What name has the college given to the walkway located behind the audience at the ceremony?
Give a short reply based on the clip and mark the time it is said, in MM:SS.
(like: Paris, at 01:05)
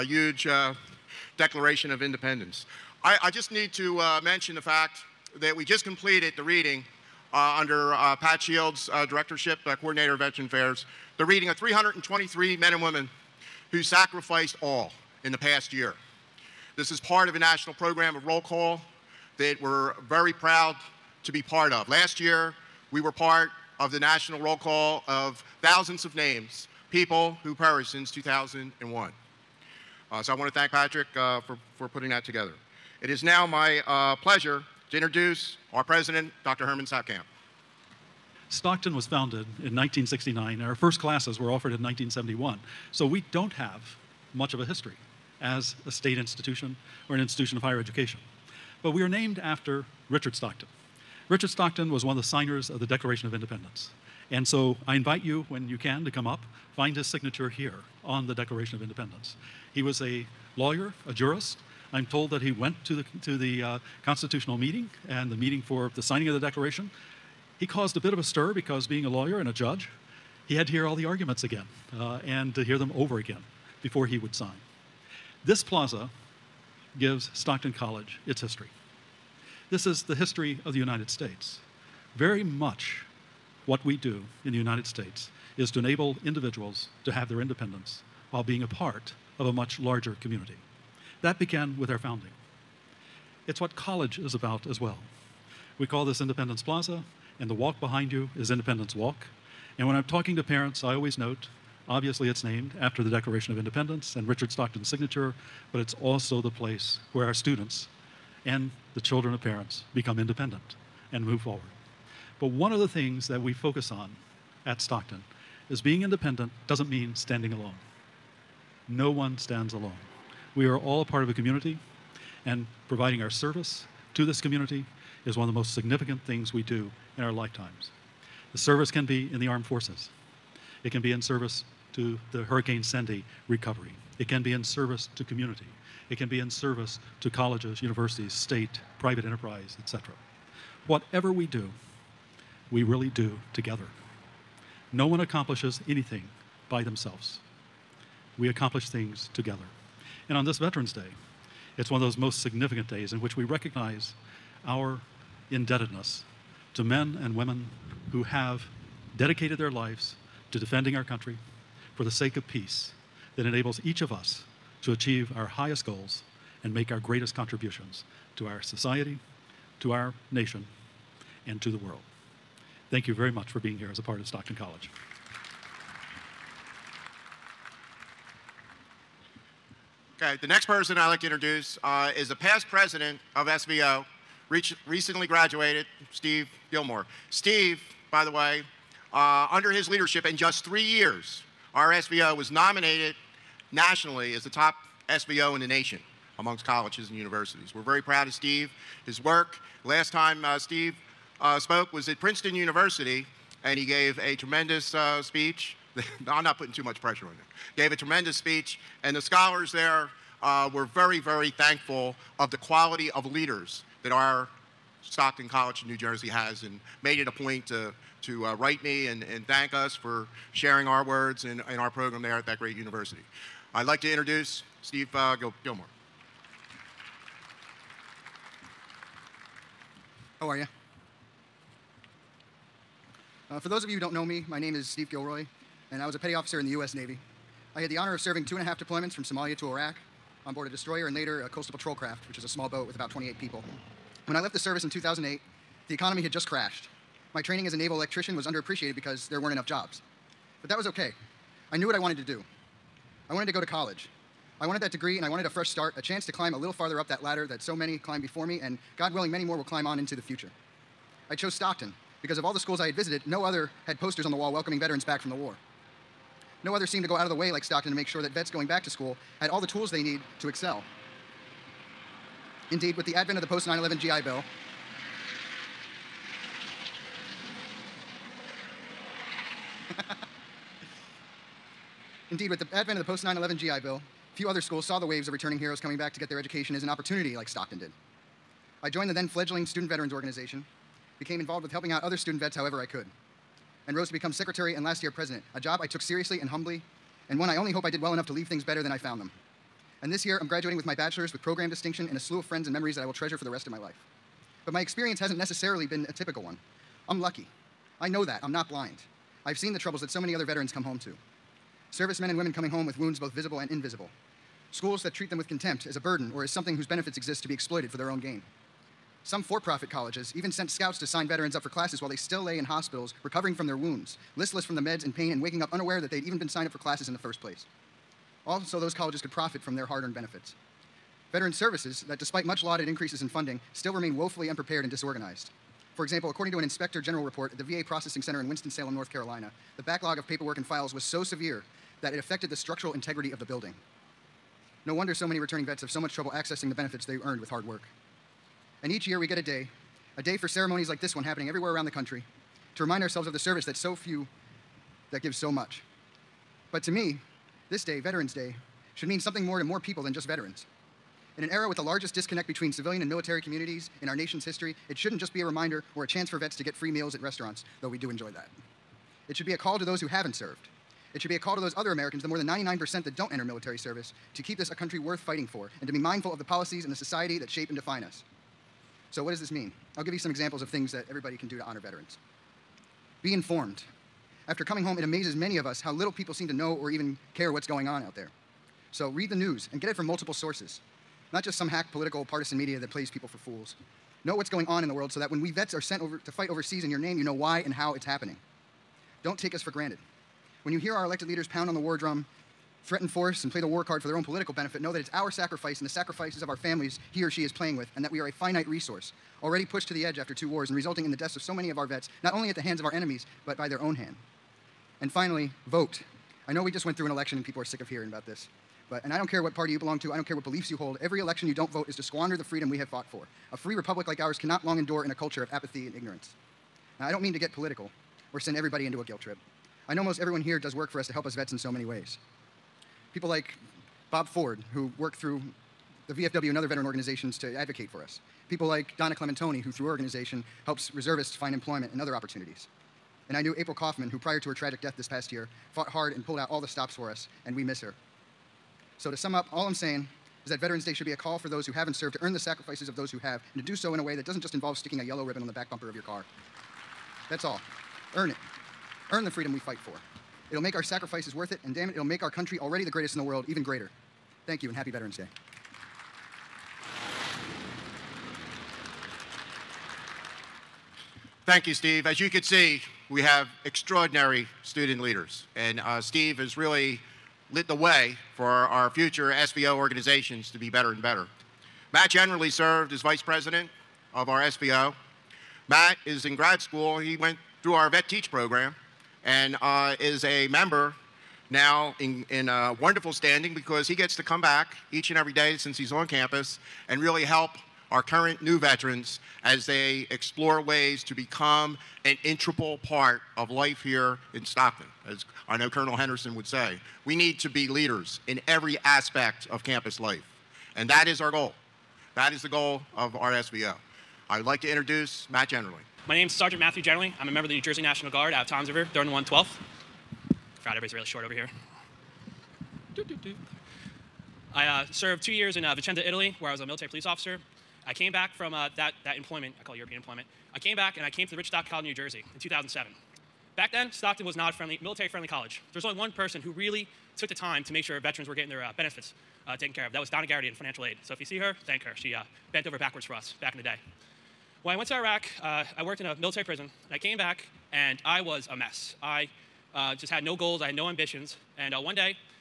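Independence Walk, at 01:38.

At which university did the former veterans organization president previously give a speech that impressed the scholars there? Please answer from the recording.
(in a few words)
Princeton University.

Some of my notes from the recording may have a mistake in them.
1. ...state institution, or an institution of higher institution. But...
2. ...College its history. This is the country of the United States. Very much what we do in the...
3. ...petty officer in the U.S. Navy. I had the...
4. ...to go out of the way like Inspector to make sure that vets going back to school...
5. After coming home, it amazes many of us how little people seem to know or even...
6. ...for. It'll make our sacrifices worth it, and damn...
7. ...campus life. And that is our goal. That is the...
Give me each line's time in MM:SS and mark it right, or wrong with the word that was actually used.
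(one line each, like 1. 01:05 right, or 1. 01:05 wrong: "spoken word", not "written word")
1. 00:45 wrong: "education", not "institution"
2. 01:17 wrong: "history", not "country"
3. 03:56 right
4. 04:27 wrong: "Stockton", not "Inspector"
5. 06:24 right
6. 07:39 right
7. 08:29 right.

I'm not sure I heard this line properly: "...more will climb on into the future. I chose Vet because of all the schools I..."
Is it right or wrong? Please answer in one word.
wrong.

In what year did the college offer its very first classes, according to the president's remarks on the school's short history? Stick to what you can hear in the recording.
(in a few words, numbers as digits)
1971.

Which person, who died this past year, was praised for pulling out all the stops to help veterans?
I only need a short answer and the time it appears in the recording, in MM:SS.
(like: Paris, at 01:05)
April Kauffman, at 07:23.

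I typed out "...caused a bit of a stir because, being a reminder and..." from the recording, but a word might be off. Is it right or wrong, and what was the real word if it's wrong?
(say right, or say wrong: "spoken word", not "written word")
wrong: "lawyer", not "reminder".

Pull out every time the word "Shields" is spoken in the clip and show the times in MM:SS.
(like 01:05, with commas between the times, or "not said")
00:08.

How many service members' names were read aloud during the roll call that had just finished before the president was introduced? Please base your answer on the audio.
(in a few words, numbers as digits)
323.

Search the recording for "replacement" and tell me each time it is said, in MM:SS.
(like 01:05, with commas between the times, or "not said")
not said.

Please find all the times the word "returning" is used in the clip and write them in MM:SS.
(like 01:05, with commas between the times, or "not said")
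04:45, 05:45.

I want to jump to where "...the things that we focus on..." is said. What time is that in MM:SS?
01:52.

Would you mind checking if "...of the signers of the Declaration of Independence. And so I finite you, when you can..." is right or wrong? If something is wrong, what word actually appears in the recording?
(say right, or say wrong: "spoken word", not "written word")
wrong: "invite", not "finite".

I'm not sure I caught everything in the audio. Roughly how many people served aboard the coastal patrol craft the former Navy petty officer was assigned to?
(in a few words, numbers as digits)
28.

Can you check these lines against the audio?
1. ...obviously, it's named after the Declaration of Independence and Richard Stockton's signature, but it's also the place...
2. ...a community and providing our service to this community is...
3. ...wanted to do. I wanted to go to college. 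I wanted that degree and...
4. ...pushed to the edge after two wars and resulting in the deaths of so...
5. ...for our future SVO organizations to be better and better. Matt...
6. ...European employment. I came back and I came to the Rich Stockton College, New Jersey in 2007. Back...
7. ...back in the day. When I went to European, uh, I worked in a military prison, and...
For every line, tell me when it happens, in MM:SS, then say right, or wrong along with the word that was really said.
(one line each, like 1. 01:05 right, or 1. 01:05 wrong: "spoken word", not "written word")
1. 01:41 right
2. 02:01 right
3. 04:11 right
4. 06:49 right
5. 07:58 right
6. 08:49 right
7. 09:03 wrong: "Iraq", not "European".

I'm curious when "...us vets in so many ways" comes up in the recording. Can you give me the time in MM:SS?
07:11.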